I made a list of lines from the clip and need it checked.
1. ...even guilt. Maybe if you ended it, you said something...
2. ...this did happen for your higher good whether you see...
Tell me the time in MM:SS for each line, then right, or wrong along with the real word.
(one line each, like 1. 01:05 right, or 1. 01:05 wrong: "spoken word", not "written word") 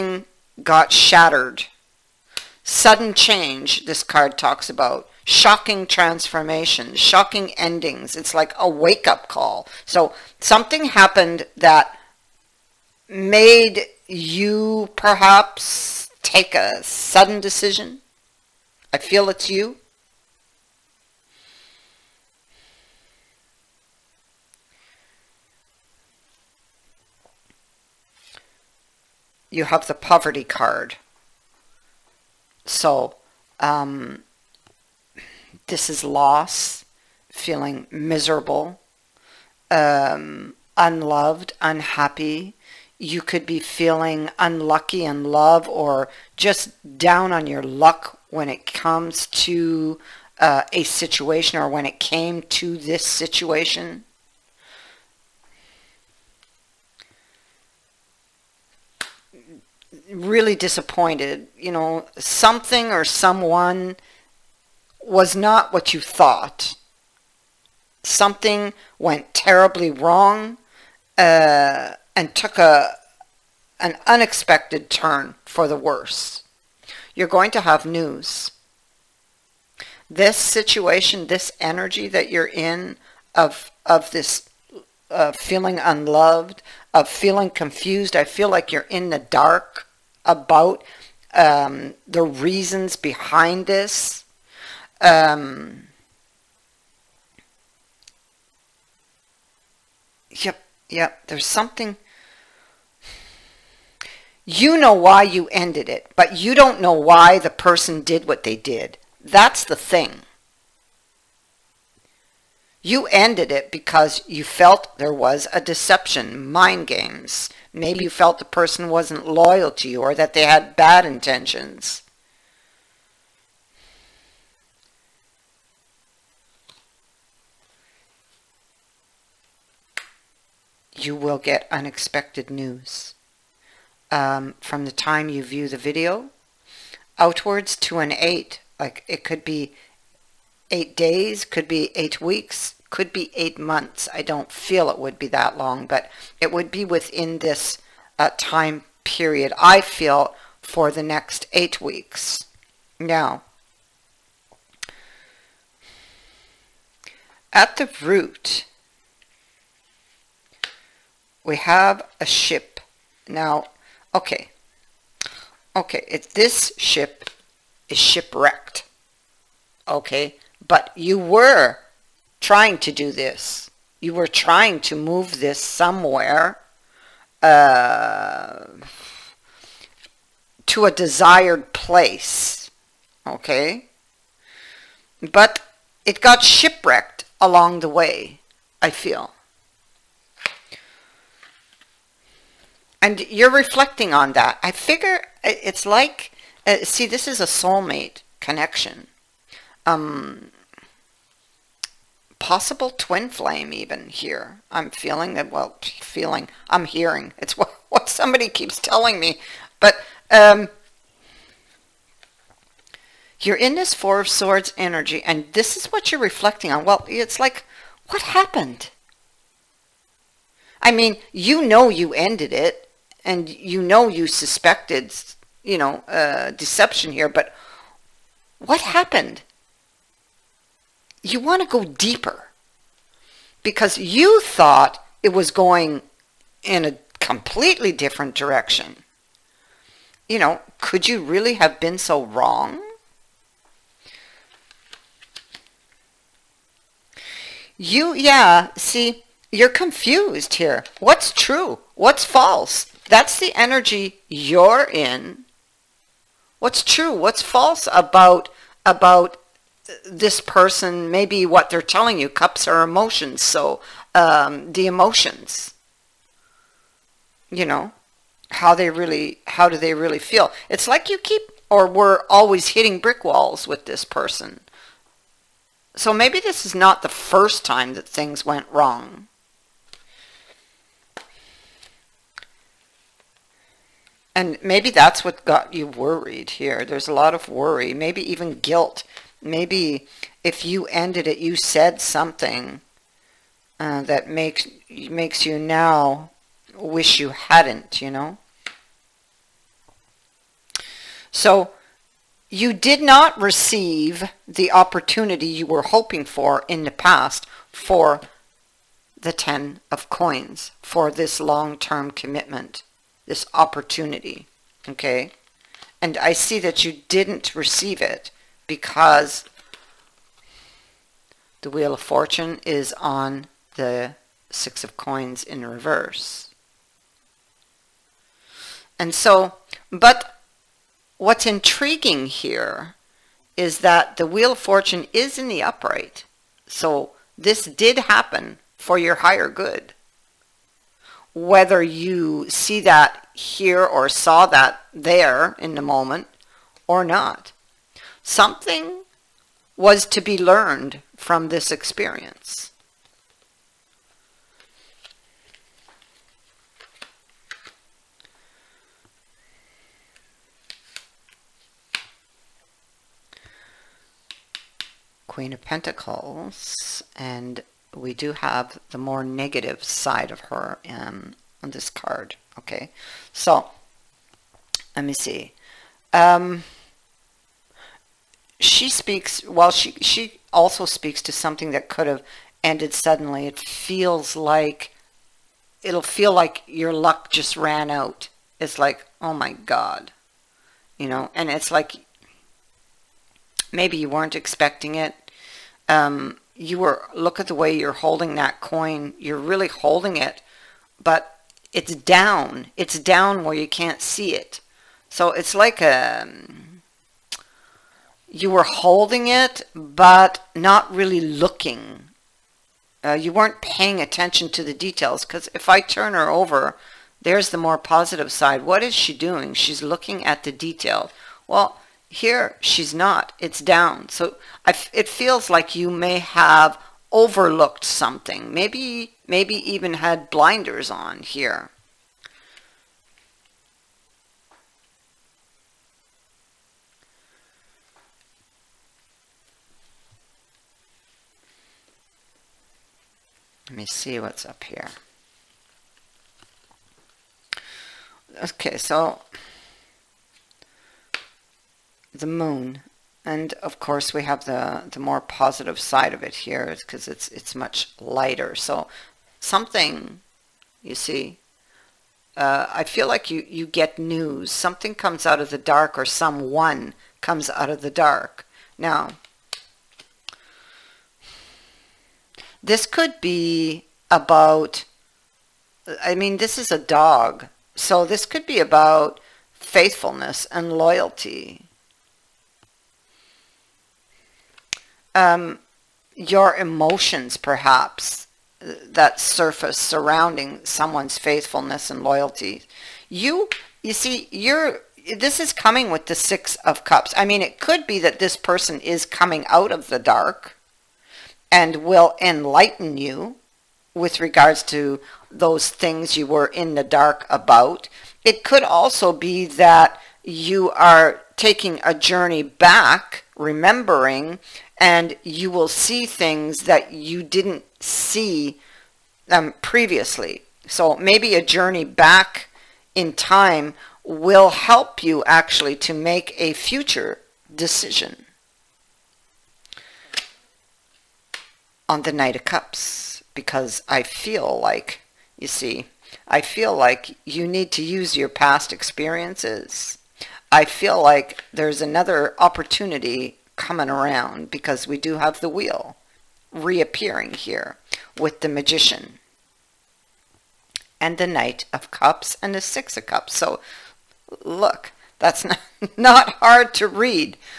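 1. 04:48 right
2. 05:37 right.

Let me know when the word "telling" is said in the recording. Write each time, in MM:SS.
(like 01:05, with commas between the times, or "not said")
03:28, 04:21.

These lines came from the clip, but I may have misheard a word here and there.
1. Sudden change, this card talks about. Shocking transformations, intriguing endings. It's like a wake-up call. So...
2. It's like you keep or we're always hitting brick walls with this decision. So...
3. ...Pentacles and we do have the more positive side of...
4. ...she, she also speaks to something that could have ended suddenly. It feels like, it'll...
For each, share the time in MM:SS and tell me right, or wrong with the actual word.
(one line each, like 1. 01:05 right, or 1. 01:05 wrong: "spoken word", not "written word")
1. 00:02 wrong: "shocking", not "intriguing"
2. 04:30 wrong: "person", not "decision"
3. 06:05 wrong: "negative", not "positive"
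4. 06:19 right.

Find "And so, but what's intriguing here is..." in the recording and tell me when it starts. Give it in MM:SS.
05:28.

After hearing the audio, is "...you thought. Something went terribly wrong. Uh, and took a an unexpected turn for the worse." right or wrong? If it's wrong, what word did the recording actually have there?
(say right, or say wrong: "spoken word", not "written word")
right.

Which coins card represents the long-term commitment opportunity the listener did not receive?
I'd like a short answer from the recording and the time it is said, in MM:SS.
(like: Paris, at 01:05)
10 of coins, at 05:09.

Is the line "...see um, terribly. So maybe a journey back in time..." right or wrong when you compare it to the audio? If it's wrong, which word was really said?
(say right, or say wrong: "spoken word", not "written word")
wrong: "previously", not "terribly".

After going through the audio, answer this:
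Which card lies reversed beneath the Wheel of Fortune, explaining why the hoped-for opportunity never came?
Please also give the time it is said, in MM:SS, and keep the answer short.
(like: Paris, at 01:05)
Six of Coins, at 05:24.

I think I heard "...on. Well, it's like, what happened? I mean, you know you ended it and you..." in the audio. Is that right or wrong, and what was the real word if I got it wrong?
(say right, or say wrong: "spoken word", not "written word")
right.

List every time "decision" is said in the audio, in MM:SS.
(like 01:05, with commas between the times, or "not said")
00:17, 08:47.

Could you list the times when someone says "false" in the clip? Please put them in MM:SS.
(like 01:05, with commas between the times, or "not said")
04:12, 04:17.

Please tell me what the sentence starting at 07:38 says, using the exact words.
So something, you see, uh, I feel like you, you get news.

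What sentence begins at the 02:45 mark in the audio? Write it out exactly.
Okay, if this ship is shipwrecked, okay, but you were trying to do this.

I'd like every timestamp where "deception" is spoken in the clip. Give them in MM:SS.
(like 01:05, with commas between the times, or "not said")
01:55, 03:46.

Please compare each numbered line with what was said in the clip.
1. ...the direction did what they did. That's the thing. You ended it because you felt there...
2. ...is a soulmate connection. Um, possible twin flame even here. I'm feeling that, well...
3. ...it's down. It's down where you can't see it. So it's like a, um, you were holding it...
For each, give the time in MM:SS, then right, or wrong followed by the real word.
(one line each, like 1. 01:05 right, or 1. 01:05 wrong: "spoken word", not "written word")
1. 01:47 wrong: "person", not "direction"
2. 03:17 right
3. 06:41 right.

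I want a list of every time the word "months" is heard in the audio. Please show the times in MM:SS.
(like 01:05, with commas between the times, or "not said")
02:23.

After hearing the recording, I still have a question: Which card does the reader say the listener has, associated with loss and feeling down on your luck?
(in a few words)
Poverty card.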